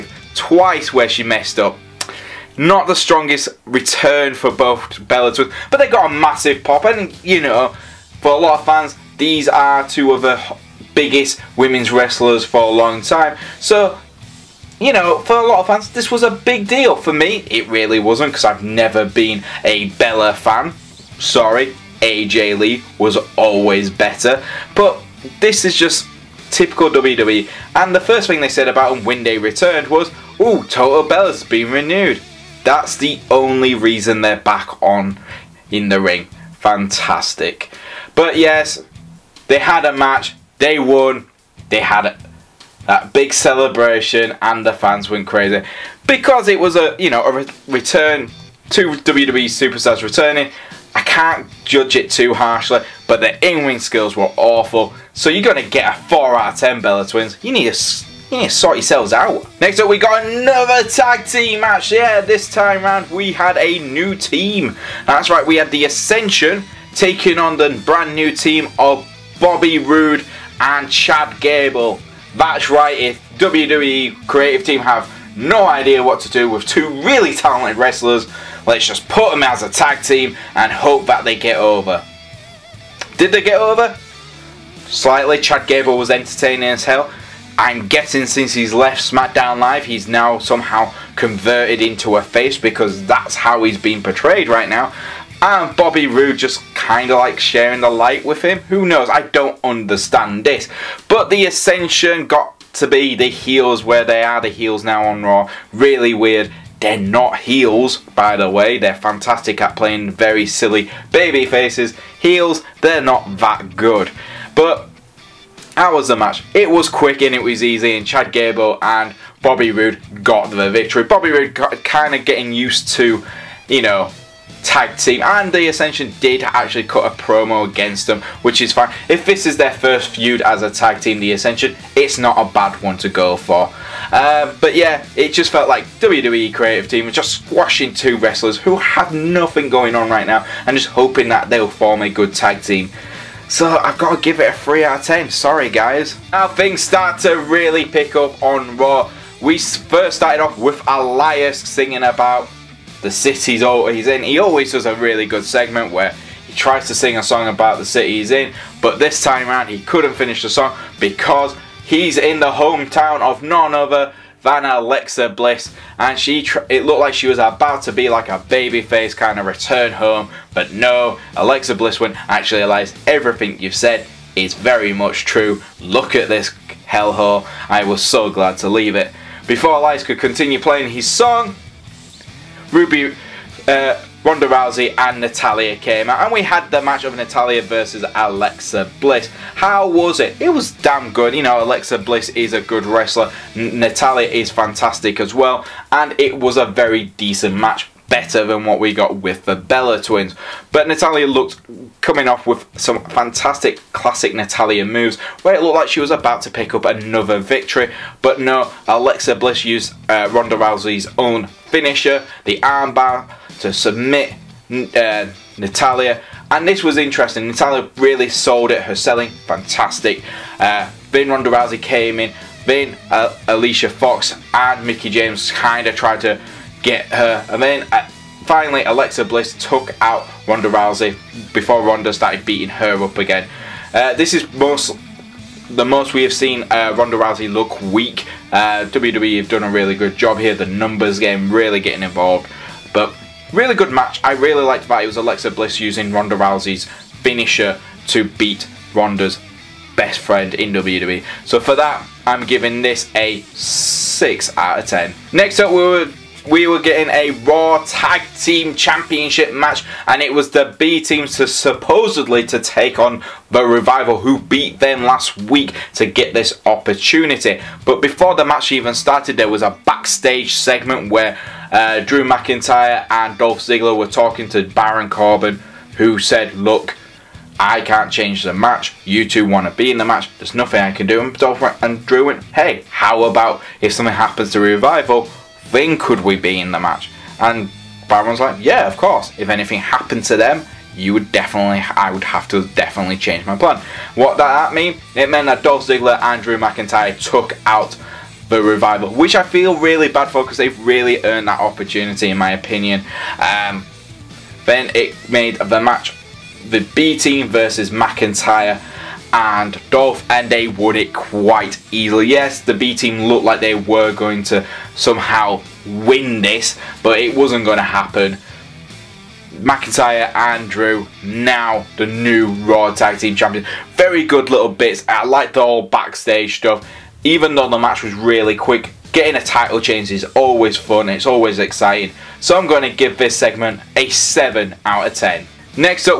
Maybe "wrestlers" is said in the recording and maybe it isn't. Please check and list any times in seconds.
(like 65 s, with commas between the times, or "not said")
11 s, 77 s, 138 s, 192 s.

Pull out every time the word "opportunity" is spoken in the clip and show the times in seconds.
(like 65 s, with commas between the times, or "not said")
266 s, 301 s.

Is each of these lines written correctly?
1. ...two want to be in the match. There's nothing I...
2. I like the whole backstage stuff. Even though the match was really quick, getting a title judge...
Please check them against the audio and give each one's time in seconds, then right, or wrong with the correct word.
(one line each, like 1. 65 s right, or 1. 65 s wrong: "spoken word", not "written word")
1. 279 s right
2. 325 s wrong: "change", not "judge".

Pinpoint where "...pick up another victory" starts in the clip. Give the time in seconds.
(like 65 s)
206 s.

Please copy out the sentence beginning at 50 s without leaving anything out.
I can't judge it too harshly, but their in-ring skills were awful.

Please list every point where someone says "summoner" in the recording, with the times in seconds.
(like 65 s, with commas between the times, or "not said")
not said.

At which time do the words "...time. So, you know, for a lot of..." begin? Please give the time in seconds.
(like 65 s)
13 s.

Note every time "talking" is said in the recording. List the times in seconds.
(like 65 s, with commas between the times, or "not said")
274 s.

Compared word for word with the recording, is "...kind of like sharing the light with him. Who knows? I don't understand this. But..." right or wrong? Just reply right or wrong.
right.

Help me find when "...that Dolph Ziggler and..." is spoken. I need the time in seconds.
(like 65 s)
295 s.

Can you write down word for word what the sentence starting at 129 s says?
If this is their first feud as a tag team, the Ascension, it's not a bad one to go for.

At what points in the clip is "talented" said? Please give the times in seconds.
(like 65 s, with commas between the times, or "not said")
77 s.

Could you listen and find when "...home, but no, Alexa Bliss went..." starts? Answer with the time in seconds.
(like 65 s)
169 s.